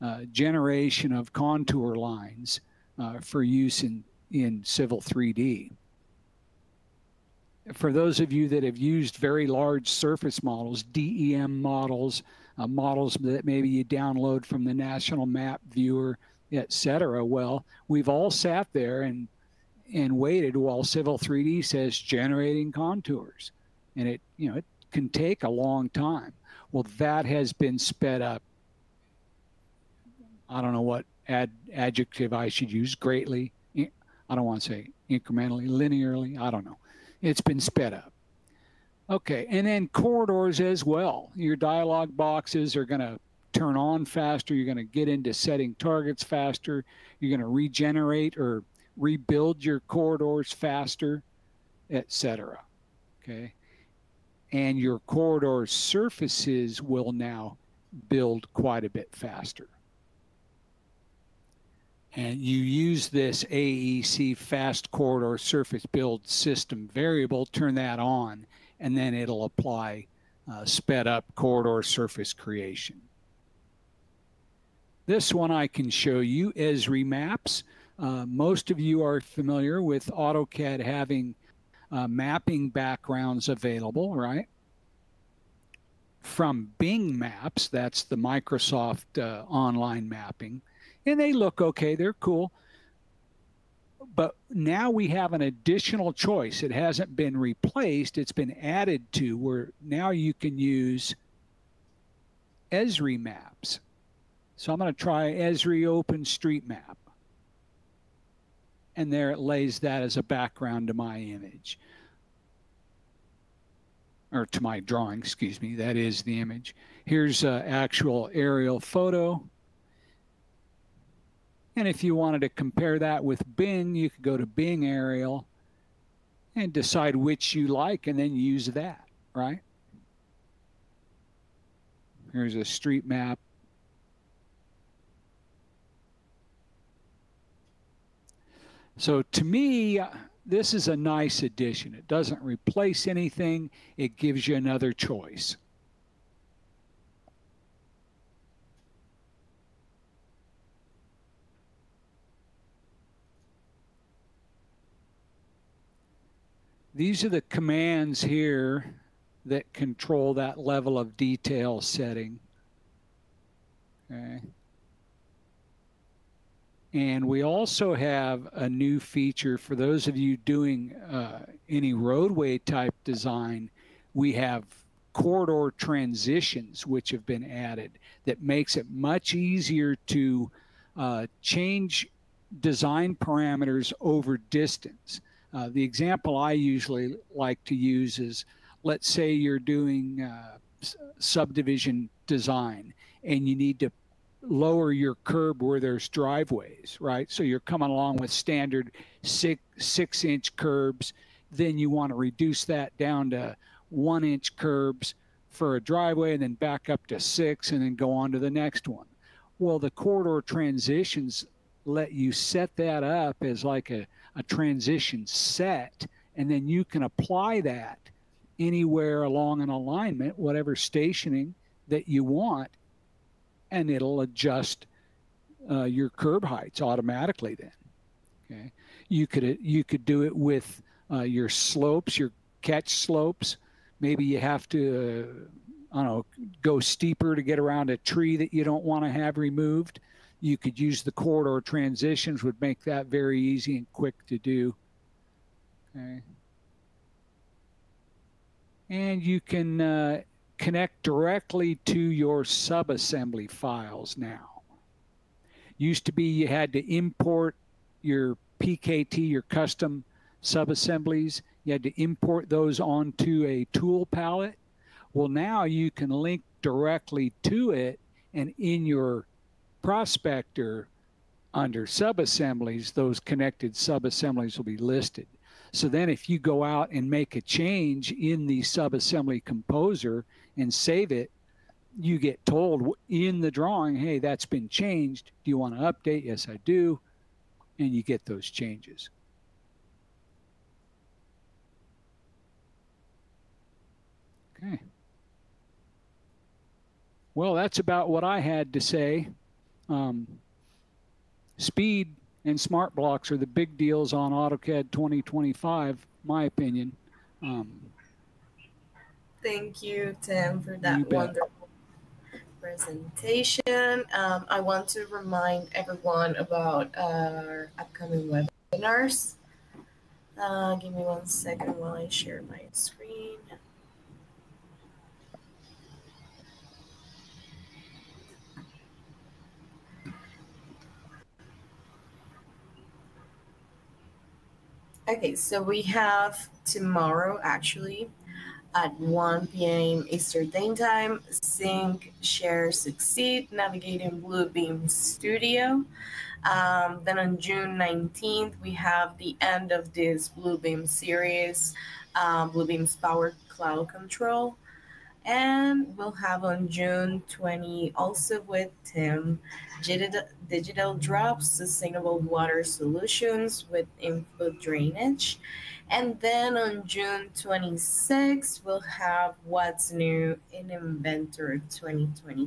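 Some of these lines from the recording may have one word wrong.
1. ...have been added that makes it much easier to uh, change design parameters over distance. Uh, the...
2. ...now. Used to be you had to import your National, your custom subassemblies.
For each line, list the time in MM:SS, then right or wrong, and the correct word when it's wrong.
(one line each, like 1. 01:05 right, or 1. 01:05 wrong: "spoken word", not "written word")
1. 02:57 right
2. 04:14 wrong: "PKT", not "National".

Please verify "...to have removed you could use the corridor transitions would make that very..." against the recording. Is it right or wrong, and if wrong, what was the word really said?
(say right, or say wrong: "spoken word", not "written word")
right.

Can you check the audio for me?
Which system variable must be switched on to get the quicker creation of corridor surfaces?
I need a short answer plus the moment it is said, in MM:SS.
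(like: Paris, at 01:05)
AEC fast corridor surface build, at 01:03.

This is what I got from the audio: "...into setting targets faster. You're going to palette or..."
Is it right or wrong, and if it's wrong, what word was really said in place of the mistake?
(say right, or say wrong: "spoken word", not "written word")
wrong: "regenerate", not "palette".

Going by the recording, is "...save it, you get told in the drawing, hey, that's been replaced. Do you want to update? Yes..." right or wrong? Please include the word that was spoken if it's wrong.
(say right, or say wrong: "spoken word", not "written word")
wrong: "changed", not "replaced".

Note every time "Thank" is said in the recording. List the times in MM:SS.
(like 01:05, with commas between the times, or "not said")
05:09.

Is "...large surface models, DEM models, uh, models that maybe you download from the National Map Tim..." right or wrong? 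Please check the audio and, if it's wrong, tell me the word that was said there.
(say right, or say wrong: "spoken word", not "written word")
wrong: "Viewer", not "Tim".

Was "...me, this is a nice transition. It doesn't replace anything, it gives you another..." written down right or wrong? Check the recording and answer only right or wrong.
wrong.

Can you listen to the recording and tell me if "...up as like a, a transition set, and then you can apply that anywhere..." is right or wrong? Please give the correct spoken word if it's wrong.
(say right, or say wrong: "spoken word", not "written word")
right.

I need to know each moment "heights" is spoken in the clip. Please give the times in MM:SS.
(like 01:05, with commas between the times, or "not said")
03:46.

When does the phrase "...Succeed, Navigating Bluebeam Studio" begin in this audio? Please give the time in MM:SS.
05:42.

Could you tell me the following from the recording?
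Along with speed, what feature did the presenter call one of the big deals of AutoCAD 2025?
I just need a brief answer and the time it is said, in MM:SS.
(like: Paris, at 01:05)
smart blocks, at 05:02.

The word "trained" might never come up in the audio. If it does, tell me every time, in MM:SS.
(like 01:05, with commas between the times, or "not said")
not said.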